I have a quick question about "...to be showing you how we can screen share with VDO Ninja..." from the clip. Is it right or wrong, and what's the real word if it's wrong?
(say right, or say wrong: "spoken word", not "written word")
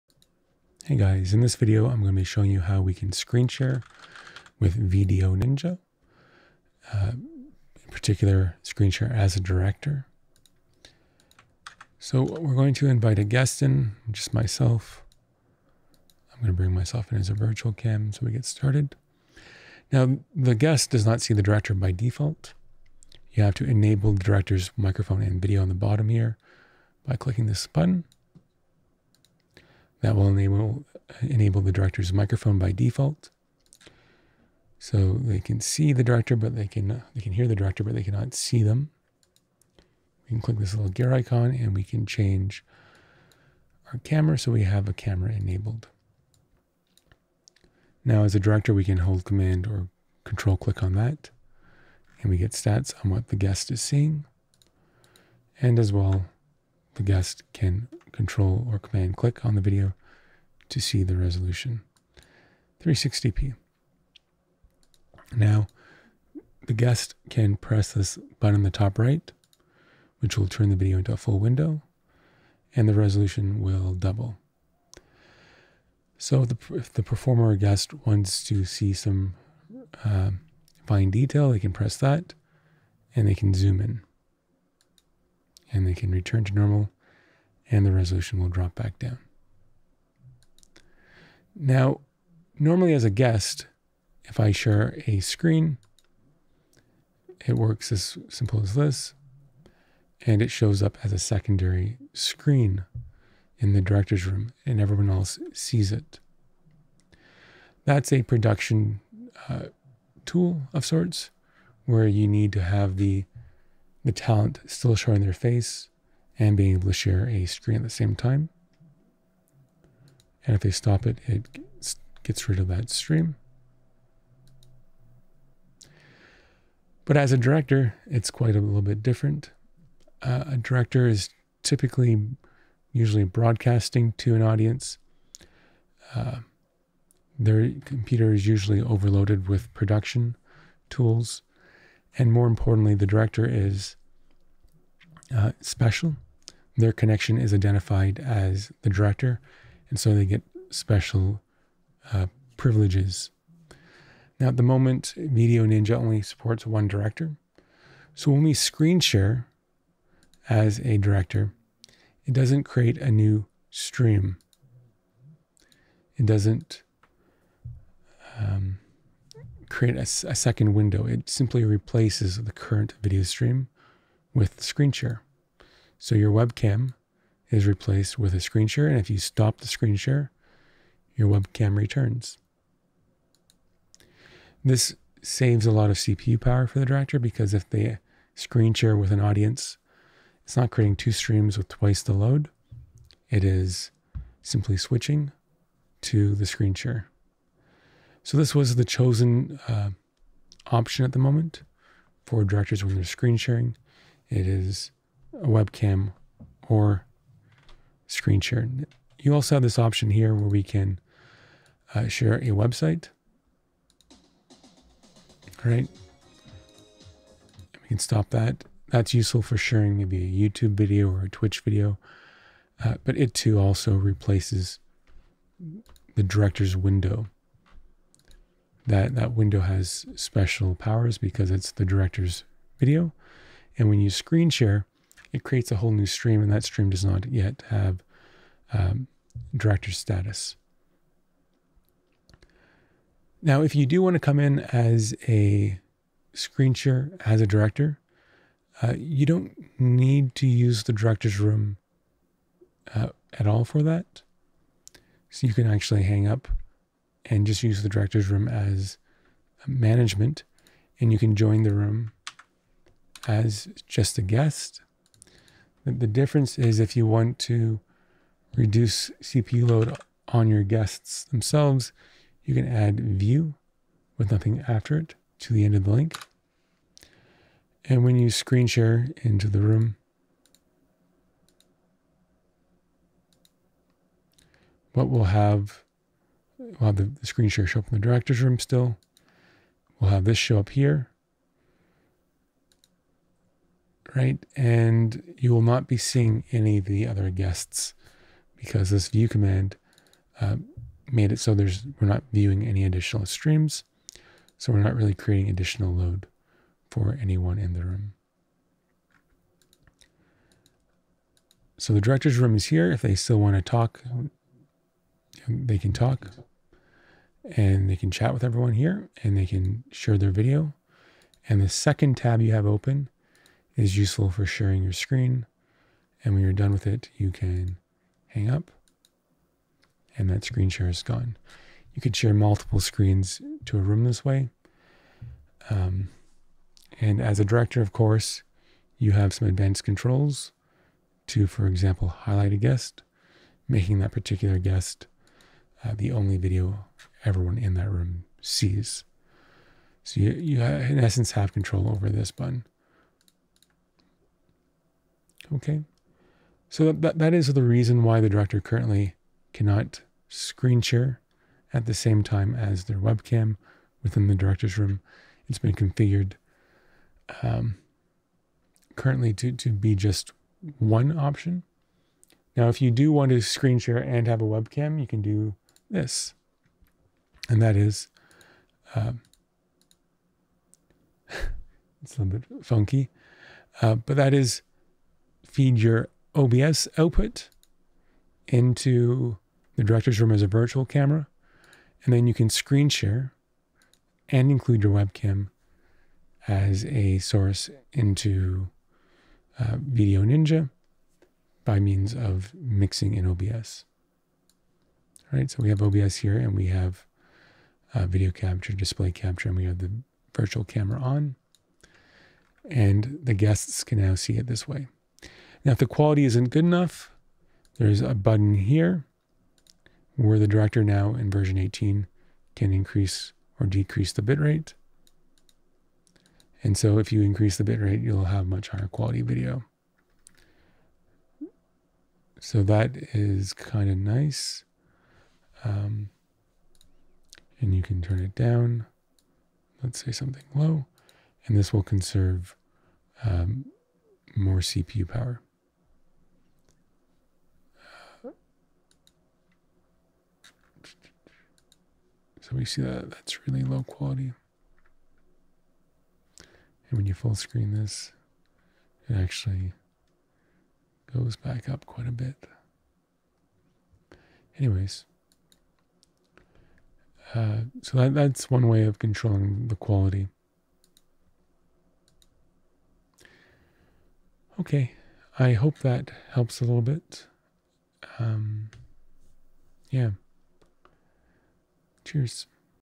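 right.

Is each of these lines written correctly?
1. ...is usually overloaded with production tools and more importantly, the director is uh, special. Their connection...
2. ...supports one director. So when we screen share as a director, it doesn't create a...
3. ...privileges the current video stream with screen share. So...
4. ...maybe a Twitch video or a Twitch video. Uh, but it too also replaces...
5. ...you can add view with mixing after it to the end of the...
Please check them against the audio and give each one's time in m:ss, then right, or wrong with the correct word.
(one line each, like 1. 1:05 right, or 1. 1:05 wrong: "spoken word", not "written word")
1. 2:18 right
2. 2:36 right
3. 2:51 wrong: "replaces", not "privileges"
4. 3:39 wrong: "YouTube", not "Twitch"
5. 4:32 wrong: "nothing", not "mixing".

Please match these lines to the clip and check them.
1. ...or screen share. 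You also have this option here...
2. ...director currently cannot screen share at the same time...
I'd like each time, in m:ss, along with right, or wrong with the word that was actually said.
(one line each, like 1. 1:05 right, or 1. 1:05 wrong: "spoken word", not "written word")
1. 3:26 right
2. 5:58 right.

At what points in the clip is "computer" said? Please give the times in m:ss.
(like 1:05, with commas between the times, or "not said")
2:17.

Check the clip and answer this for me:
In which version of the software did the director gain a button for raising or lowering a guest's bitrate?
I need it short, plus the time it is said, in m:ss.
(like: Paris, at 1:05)
18, at 7:01.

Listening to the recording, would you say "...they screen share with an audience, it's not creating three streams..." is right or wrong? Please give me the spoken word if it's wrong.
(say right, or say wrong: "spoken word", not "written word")
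wrong: "two", not "three".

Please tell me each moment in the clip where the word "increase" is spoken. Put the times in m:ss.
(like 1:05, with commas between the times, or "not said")
7:02, 7:07.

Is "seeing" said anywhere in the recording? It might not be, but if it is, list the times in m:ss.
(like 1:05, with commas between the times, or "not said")
0:53, 4:55.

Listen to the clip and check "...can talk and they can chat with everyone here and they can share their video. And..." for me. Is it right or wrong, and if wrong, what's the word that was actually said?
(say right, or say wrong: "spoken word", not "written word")
right.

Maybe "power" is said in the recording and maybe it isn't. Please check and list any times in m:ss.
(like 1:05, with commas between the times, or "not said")
3:06, 3:50, 7:25.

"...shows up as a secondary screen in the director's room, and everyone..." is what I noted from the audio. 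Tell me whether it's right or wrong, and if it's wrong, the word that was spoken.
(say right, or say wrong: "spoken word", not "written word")
right.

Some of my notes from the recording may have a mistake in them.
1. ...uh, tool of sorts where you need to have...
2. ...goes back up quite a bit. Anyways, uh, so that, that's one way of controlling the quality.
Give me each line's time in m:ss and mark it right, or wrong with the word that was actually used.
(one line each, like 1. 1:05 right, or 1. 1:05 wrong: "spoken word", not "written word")
1. 1:49 right
2. 7:41 right.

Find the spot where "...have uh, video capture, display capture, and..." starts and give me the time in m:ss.
6:46.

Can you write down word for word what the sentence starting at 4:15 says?
So you can actually hang up and just use the director's room as management.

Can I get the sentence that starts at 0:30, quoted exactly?
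That will enable, enable the director's microphone by default.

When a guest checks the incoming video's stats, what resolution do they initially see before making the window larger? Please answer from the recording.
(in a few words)
360p.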